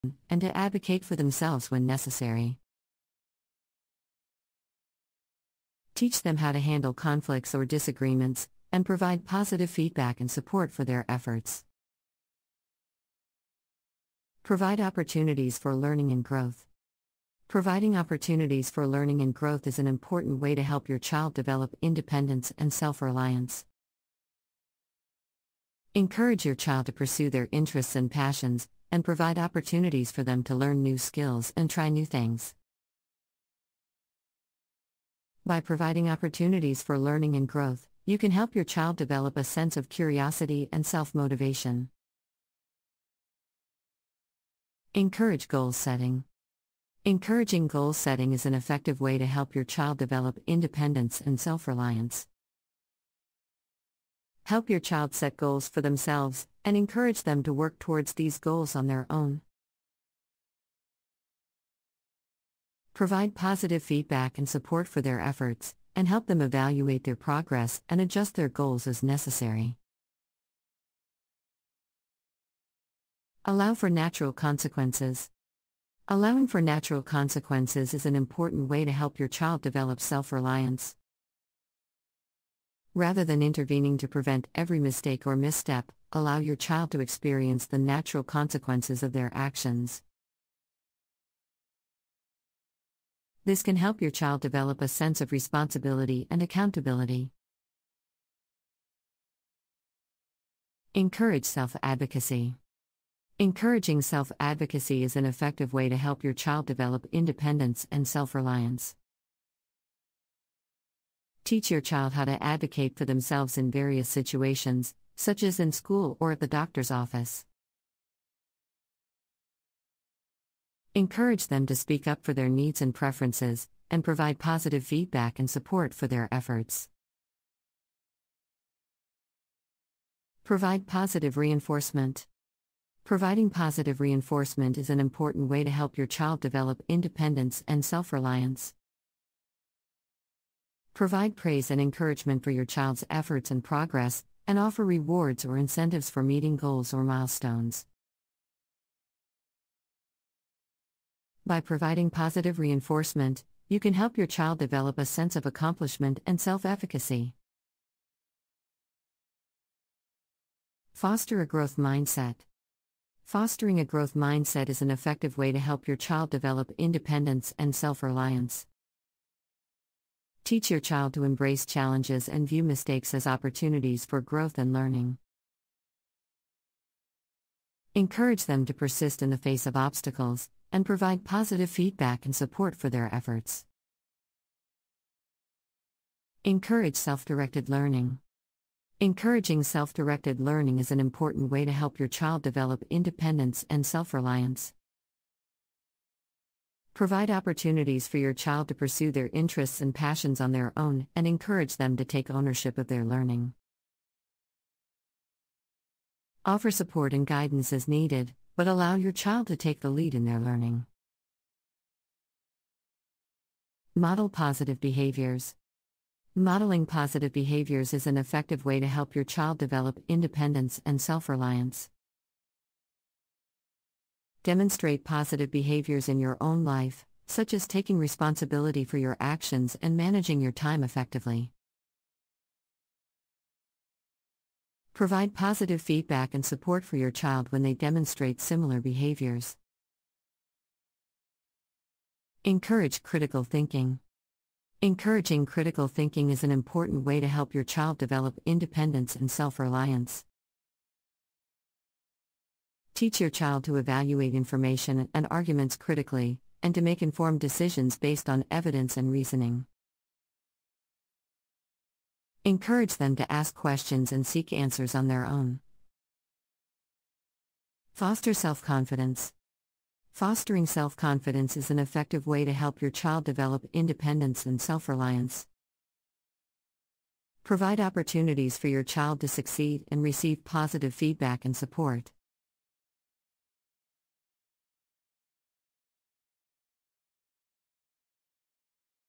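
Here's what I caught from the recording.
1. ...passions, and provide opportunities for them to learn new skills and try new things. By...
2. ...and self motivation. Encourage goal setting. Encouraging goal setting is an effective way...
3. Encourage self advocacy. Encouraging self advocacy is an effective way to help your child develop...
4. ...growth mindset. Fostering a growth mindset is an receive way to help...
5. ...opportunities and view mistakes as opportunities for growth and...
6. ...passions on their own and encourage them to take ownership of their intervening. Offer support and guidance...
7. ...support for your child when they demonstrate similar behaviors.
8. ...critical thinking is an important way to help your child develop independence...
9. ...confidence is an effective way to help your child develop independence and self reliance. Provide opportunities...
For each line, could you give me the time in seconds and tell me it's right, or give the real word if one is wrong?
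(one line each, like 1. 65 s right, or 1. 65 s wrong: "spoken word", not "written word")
1. 28 s right
2. 40 s right
3. 100 s right
4. 161 s wrong: "effective", not "receive"
5. 171 s wrong: "challenges", not "opportunities"
6. 199 s wrong: "learning", not "intervening"
7. 236 s right
8. 245 s right
9. 270 s right.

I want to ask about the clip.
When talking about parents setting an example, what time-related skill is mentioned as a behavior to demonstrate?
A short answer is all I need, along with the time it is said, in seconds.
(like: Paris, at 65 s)
managing your time effectively, at 229 s.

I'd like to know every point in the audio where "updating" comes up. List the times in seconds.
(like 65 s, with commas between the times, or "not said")
not said.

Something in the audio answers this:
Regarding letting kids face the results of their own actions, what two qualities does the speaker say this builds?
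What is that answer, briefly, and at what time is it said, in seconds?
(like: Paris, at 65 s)
responsibility and accountability, at 95 s.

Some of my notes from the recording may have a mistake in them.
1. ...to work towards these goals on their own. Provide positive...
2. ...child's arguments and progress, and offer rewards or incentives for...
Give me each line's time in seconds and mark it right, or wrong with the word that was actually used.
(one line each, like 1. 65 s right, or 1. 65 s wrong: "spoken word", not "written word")
1. 57 s right
2. 142 s wrong: "efforts", not "arguments".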